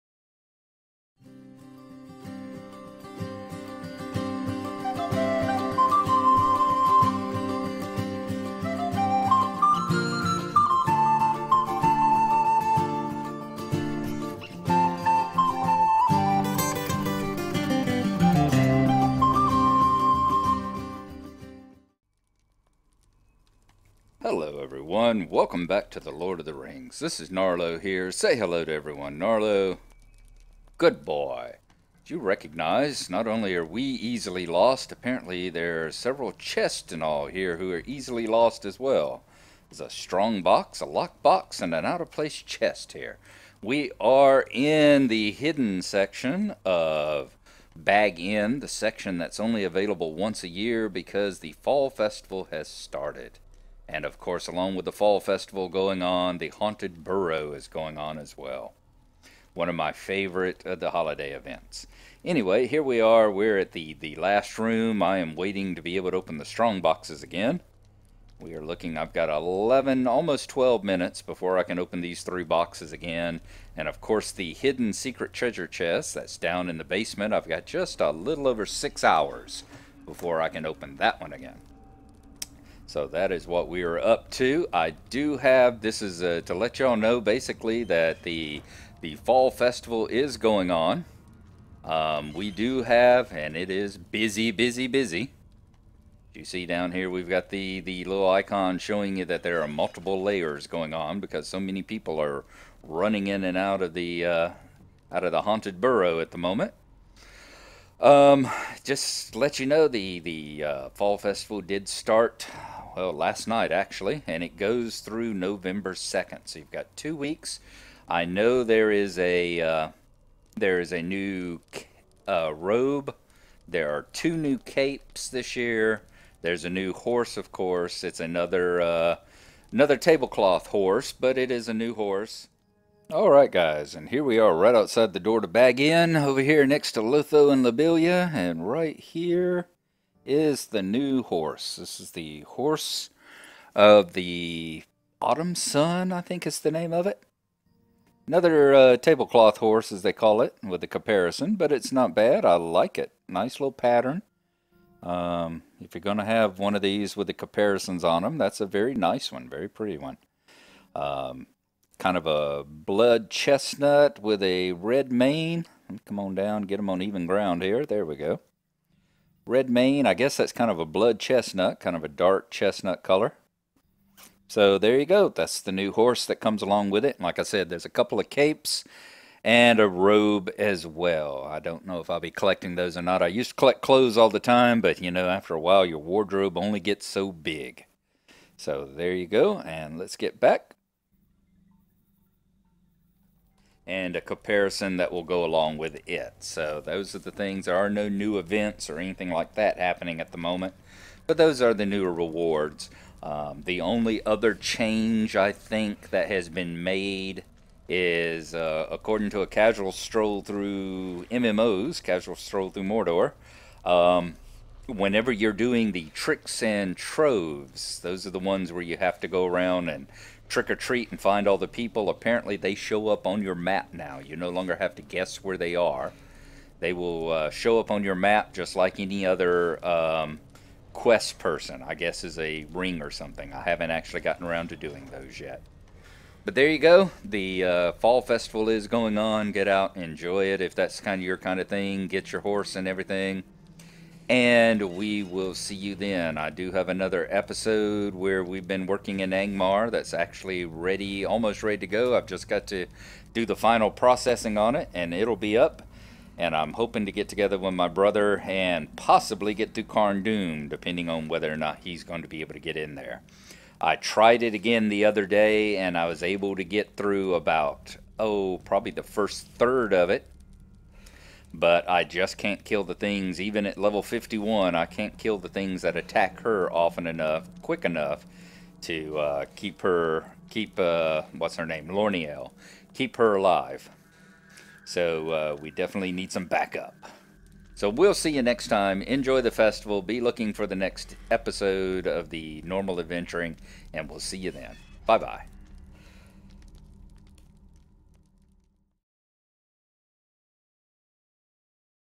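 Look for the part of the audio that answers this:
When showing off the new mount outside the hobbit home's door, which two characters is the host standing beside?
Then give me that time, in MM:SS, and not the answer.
02:17.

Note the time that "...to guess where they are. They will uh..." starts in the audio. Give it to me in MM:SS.
03:44.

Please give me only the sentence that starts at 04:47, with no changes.
So we'll see you next time.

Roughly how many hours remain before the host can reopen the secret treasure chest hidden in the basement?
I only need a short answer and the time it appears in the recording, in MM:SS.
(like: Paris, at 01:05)
6 hours, at 01:18.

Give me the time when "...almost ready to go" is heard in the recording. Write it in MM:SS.
04:11.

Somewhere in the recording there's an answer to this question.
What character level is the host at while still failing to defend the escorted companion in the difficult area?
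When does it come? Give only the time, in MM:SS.
04:34.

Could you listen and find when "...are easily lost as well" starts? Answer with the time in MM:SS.
00:37.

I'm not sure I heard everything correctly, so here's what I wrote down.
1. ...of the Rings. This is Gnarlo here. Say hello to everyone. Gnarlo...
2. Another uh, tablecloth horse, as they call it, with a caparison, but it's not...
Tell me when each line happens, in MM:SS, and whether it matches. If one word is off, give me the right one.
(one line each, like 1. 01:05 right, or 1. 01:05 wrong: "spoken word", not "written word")
1. 00:26 right
2. 02:28 right.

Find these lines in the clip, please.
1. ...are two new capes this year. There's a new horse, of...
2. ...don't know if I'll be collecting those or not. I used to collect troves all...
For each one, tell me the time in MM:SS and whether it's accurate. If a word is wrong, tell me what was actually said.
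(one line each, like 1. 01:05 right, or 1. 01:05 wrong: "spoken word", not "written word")
1. 02:03 right
2. 03:01 wrong: "clothes", not "troves".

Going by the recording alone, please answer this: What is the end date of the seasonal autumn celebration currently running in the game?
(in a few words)
November 2.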